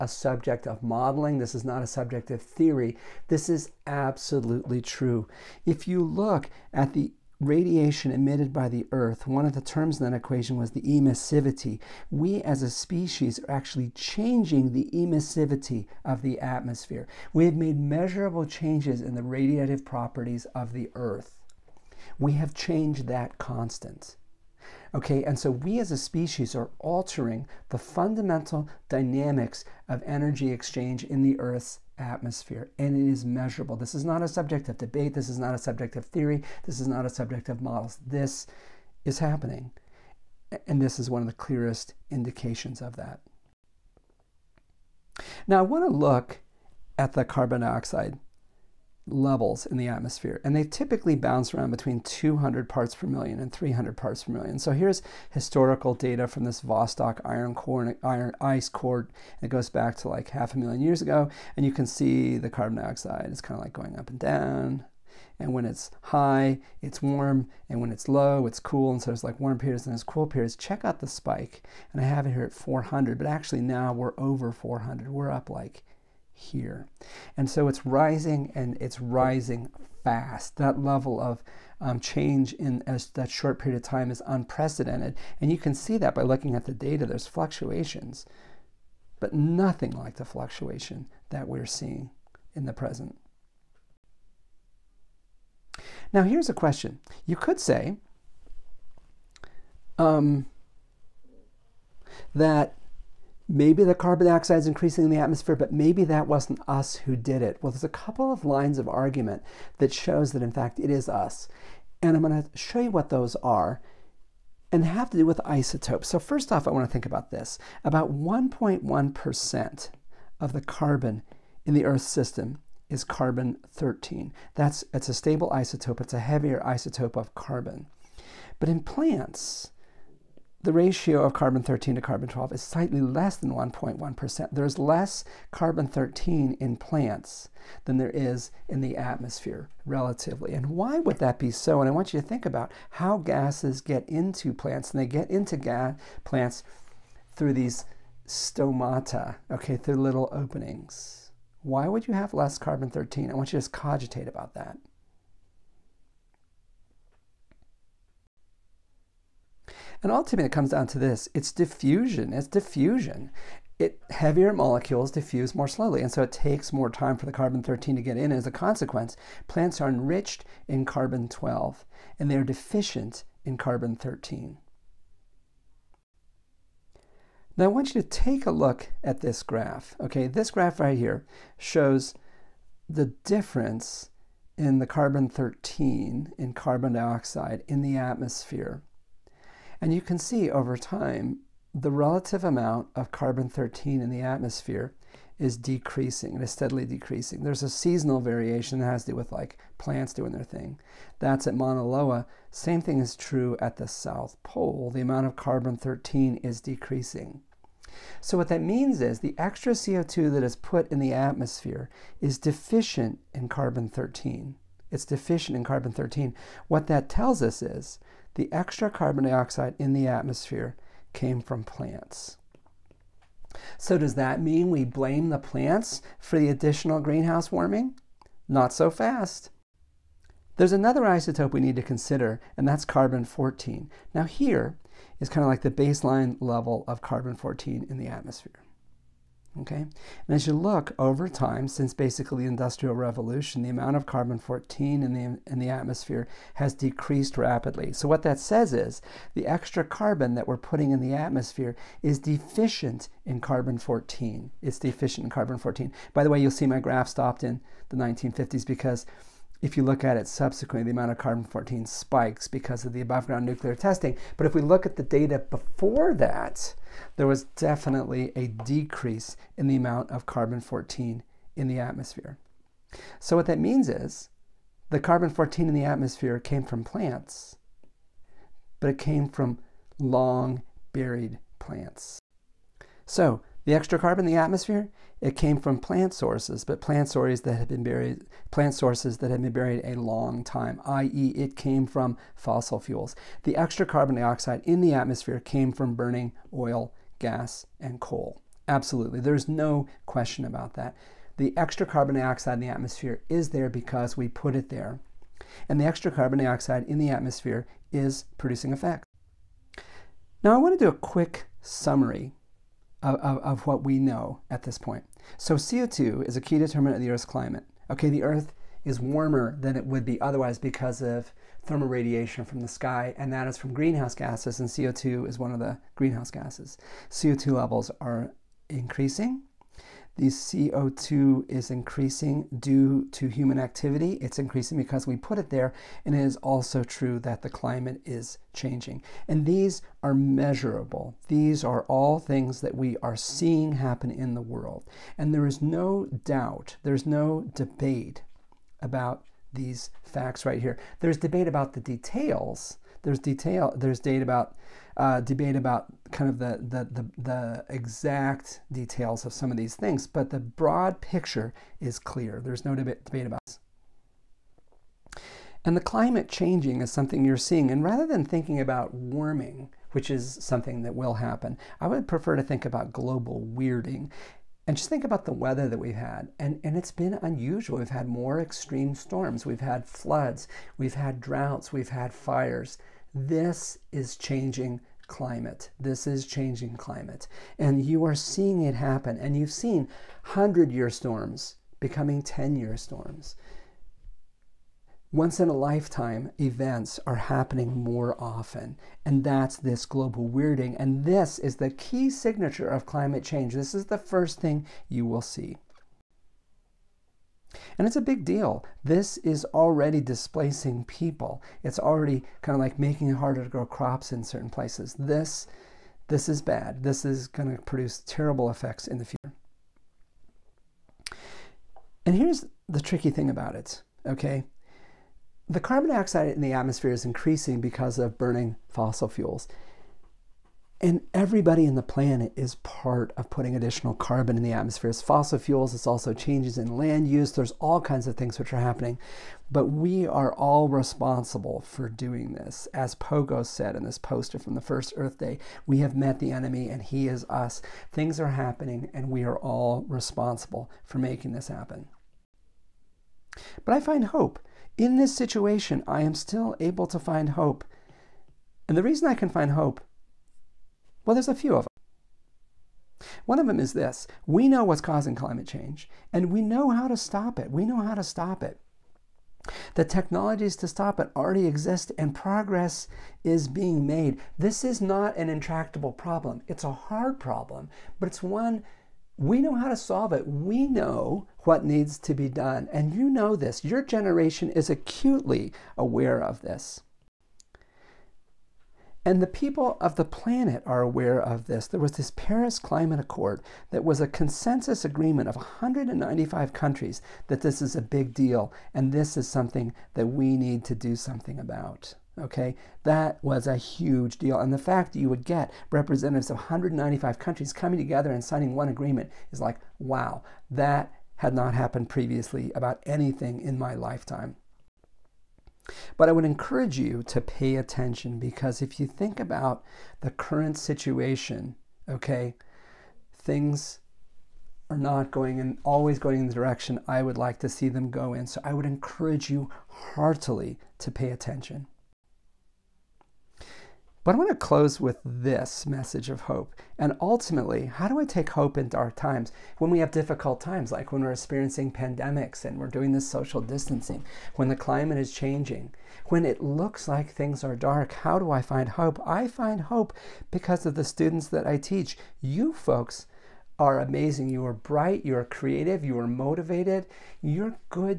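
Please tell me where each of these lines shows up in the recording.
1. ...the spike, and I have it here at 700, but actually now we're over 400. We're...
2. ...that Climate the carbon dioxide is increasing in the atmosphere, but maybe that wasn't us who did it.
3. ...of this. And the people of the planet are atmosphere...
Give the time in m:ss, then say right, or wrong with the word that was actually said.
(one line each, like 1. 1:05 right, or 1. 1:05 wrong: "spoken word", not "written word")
1. 1:10 wrong: "400", not "700"
2. 1:42 wrong: "Maybe", not "Climate"
3. 8:06 wrong: "aware", not "atmosphere".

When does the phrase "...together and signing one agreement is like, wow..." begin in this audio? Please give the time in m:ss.
8:27.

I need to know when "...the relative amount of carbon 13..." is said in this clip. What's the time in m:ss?
3:11.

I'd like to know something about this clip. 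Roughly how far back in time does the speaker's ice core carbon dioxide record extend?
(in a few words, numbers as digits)
Half a million years.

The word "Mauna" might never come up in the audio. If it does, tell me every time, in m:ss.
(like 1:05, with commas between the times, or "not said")
3:21.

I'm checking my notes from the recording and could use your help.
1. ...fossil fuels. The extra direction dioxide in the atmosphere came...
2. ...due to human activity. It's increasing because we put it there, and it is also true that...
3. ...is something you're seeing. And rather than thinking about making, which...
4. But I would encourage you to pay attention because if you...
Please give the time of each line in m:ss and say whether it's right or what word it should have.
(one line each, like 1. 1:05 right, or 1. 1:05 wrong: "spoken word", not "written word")
1. 4:52 wrong: "carbon", not "direction"
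2. 5:32 right
3. 6:06 wrong: "warming", not "making"
4. 8:35 right.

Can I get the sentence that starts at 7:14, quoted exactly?
It's fossil fuels, it's also changes in land use, there's all kinds of things which are happening.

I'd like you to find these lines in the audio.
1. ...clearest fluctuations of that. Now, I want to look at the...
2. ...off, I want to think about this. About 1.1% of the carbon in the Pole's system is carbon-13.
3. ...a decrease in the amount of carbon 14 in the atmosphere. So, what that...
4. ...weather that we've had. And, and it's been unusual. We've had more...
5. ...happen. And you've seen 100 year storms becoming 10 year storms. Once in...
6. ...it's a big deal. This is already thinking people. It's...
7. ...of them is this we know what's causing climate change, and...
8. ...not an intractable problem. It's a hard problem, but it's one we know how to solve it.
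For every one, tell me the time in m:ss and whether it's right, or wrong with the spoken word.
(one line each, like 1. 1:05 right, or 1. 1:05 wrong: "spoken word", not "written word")
1. 0:41 wrong: "indications", not "fluctuations"
2. 1:56 wrong: "Earth", not "Pole"
3. 4:28 right
4. 6:15 right
5. 6:28 right
6. 6:47 wrong: "displacing", not "thinking"
7. 7:43 right
8. 7:54 right.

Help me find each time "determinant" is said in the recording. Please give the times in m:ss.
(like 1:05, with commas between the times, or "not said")
5:16.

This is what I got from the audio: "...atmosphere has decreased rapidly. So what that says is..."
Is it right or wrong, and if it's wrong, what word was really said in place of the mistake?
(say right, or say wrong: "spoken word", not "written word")
right.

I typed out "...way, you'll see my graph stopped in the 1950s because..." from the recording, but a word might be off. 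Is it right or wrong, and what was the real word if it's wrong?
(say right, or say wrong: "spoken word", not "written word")
right.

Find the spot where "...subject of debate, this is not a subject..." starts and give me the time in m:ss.
0:34.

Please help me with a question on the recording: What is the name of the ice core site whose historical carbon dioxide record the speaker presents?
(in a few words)
Vostok.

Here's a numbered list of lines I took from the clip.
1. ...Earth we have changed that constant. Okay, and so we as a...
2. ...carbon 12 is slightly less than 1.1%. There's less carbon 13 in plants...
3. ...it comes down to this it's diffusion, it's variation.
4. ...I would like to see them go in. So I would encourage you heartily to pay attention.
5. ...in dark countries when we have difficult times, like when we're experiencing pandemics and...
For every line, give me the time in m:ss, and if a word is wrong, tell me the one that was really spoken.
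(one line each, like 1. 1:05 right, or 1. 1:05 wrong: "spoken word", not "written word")
1. 0:20 right
2. 2:12 right
3. 2:40 wrong: "diffusion", not "variation"
4. 8:46 right
5. 8:58 wrong: "times", not "countries".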